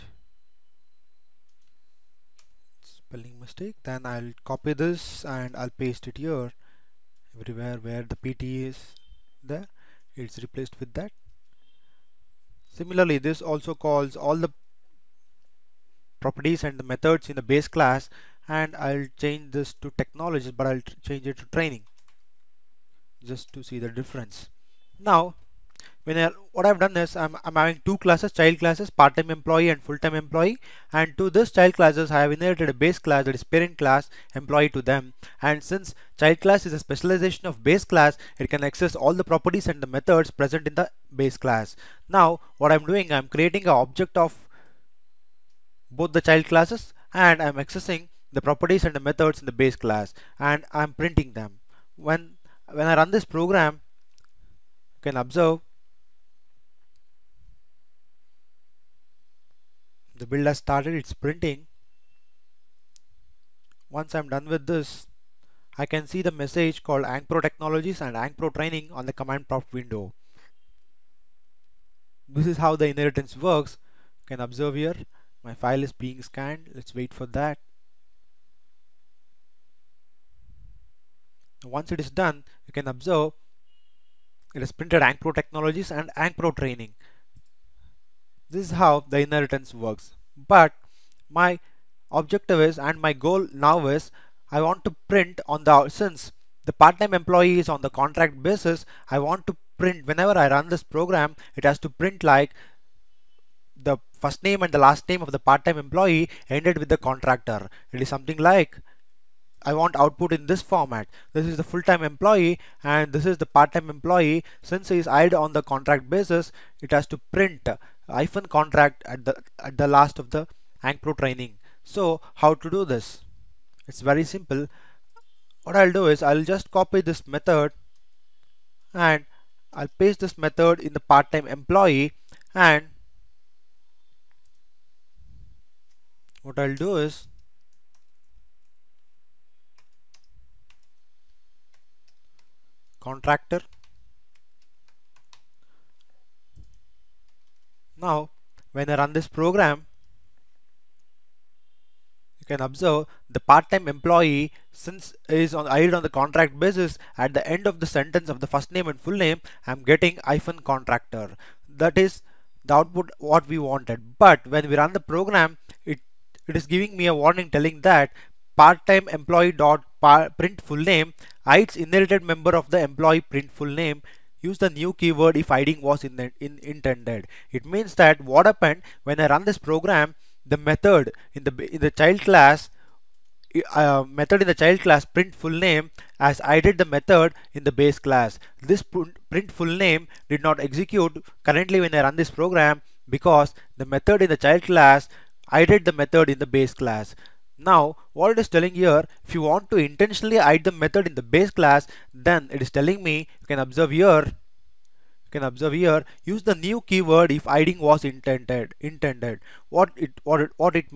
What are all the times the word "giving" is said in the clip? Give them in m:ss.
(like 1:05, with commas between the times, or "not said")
2:46.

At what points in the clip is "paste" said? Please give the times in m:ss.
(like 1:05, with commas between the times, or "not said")
0:05, 2:09.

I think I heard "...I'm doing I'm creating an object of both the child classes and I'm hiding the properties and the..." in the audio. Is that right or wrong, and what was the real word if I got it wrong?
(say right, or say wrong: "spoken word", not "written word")
wrong: "accessing", not "hiding".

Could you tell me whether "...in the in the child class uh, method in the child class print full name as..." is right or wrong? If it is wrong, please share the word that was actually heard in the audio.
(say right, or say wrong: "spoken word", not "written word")
right.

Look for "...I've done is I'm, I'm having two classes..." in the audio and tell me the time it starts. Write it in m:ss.
0:26.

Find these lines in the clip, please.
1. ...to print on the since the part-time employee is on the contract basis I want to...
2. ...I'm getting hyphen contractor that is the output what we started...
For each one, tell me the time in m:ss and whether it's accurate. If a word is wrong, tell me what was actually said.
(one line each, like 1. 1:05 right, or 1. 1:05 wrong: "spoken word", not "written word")
1. 1:34 right
2. 2:39 wrong: "wanted", not "started".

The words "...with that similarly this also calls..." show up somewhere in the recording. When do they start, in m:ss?
0:10.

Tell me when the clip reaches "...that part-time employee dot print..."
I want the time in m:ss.
2:47.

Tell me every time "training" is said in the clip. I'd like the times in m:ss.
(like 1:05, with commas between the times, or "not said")
0:21, 1:08, 1:26, 2:01.